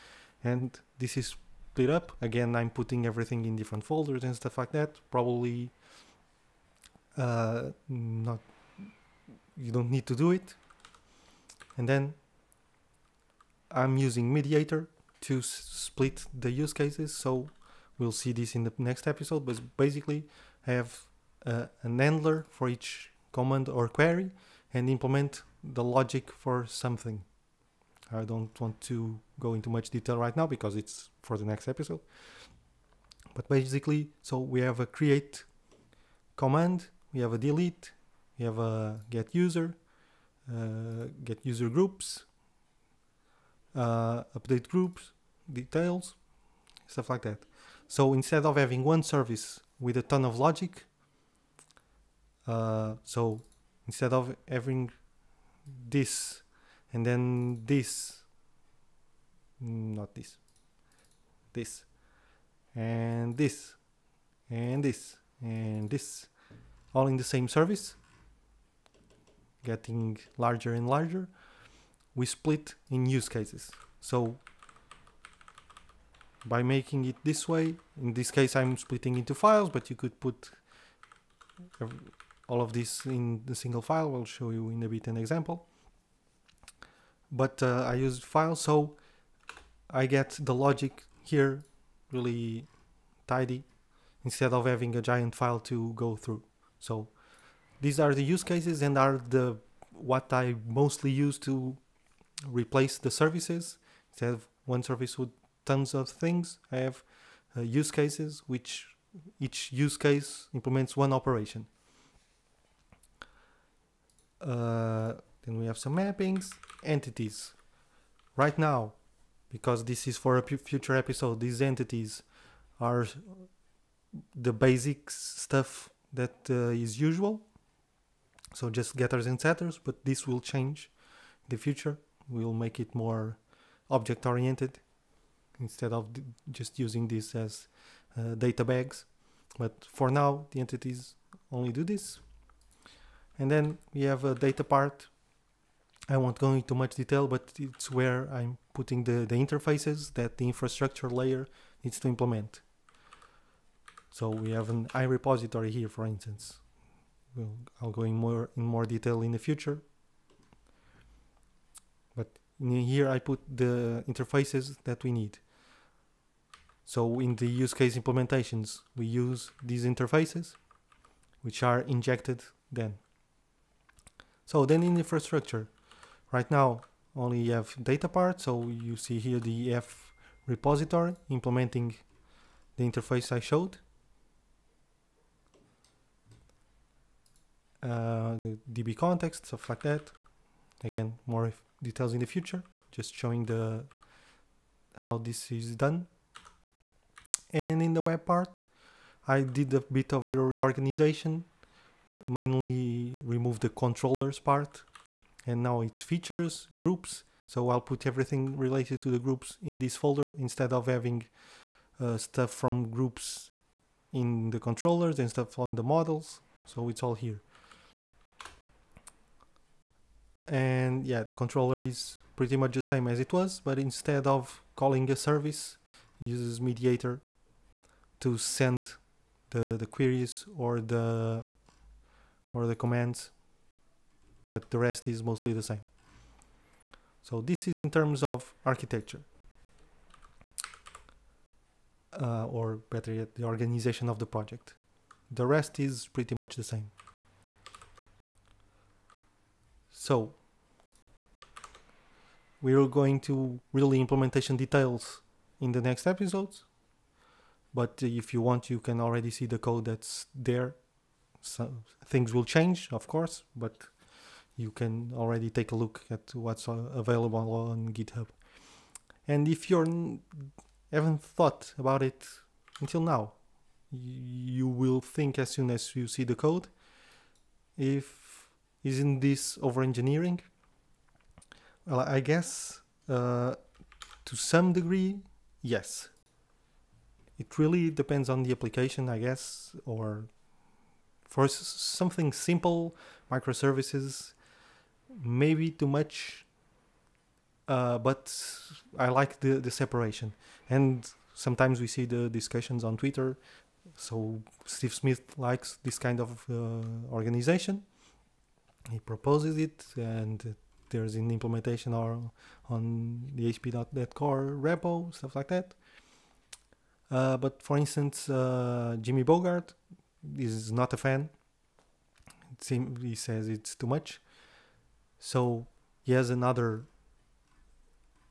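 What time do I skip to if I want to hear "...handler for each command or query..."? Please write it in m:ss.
0:21.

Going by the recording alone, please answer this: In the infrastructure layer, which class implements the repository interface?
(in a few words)
EF repository.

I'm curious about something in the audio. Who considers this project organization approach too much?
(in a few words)
Jimmy Bogard.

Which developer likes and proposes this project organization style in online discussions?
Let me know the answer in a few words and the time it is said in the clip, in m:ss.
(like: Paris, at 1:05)
Steve Smith, at 5:04.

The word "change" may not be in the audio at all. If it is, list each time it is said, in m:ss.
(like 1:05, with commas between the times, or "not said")
2:10, 4:22.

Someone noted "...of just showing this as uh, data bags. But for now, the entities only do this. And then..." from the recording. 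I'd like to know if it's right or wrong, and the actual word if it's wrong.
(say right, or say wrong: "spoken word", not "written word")
wrong: "using", not "showing".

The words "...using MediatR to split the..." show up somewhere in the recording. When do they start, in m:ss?
0:13.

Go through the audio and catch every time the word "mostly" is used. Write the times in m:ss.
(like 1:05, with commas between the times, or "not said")
1:40, 3:55.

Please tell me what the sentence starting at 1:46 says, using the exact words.
I have uh, use cases, which each use case implements one operation.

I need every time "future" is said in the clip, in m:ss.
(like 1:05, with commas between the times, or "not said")
2:00, 2:11, 2:39, 3:12.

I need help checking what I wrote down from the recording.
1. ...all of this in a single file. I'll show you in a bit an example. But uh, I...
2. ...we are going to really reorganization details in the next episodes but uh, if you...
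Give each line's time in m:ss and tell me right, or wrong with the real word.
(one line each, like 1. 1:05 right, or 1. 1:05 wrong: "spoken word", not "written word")
1. 1:22 right
2. 4:12 wrong: "implementation", not "reorganization".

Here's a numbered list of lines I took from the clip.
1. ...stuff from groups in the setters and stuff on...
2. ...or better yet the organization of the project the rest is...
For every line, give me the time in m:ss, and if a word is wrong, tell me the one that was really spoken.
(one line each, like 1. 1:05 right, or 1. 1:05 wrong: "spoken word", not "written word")
1. 3:32 wrong: "controllers", not "setters"
2. 4:02 right.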